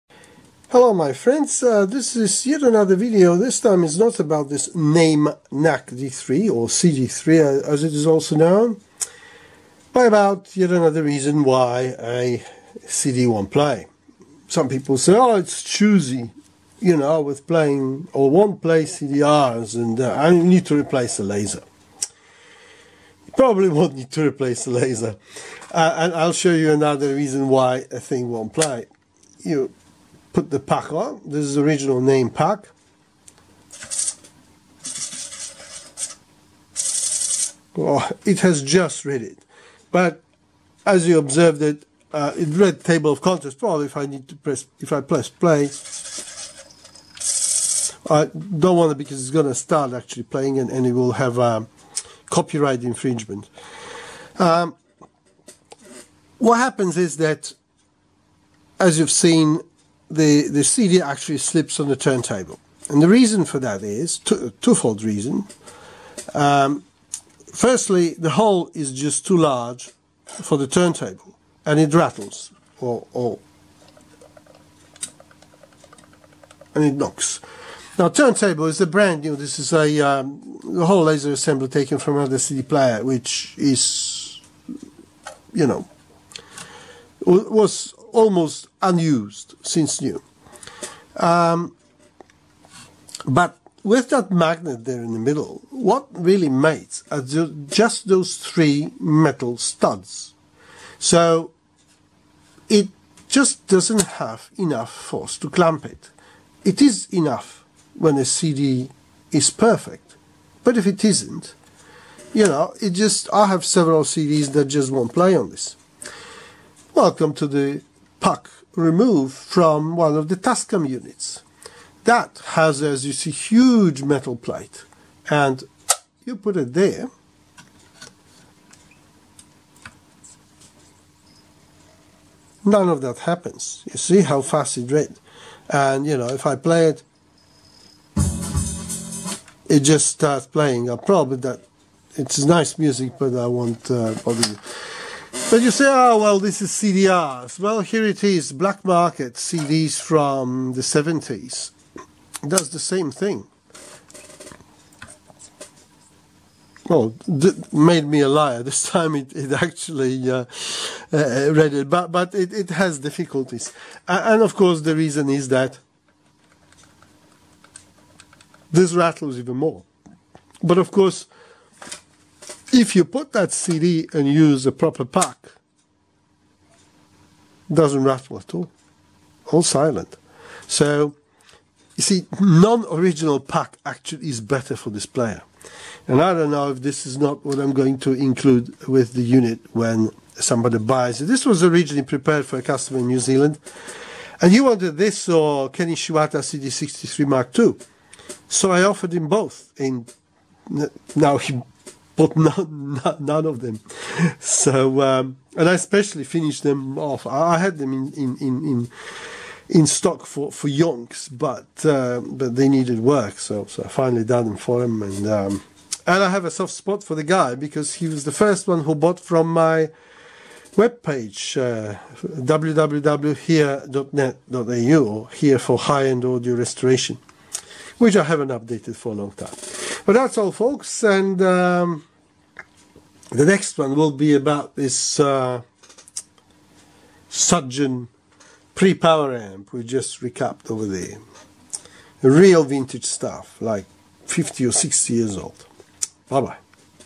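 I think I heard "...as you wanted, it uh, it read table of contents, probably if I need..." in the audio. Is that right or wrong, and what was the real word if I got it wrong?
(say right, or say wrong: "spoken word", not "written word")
wrong: "observed", not "wanted".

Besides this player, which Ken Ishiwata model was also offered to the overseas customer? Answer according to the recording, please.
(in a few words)
CD63 Mark II.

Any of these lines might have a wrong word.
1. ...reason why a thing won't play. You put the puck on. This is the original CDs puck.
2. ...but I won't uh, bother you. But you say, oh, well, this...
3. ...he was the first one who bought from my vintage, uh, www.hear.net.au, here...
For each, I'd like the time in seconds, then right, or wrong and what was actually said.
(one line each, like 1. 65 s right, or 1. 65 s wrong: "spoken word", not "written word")
1. 27 s wrong: "Naim", not "CDs"
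2. 143 s right
3. 217 s wrong: "webpage", not "vintage".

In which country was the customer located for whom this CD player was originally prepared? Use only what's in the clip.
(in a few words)
New Zealand.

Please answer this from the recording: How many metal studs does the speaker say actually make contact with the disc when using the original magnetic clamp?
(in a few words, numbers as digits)
3.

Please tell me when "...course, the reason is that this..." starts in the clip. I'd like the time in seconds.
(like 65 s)
164 s.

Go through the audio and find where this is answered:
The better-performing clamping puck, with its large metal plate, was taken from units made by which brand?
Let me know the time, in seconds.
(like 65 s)
120 s.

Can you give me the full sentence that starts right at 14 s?
Some people say, oh it's choosy, you know, with playing or won't play CDRs and uh, I need to replace the laser.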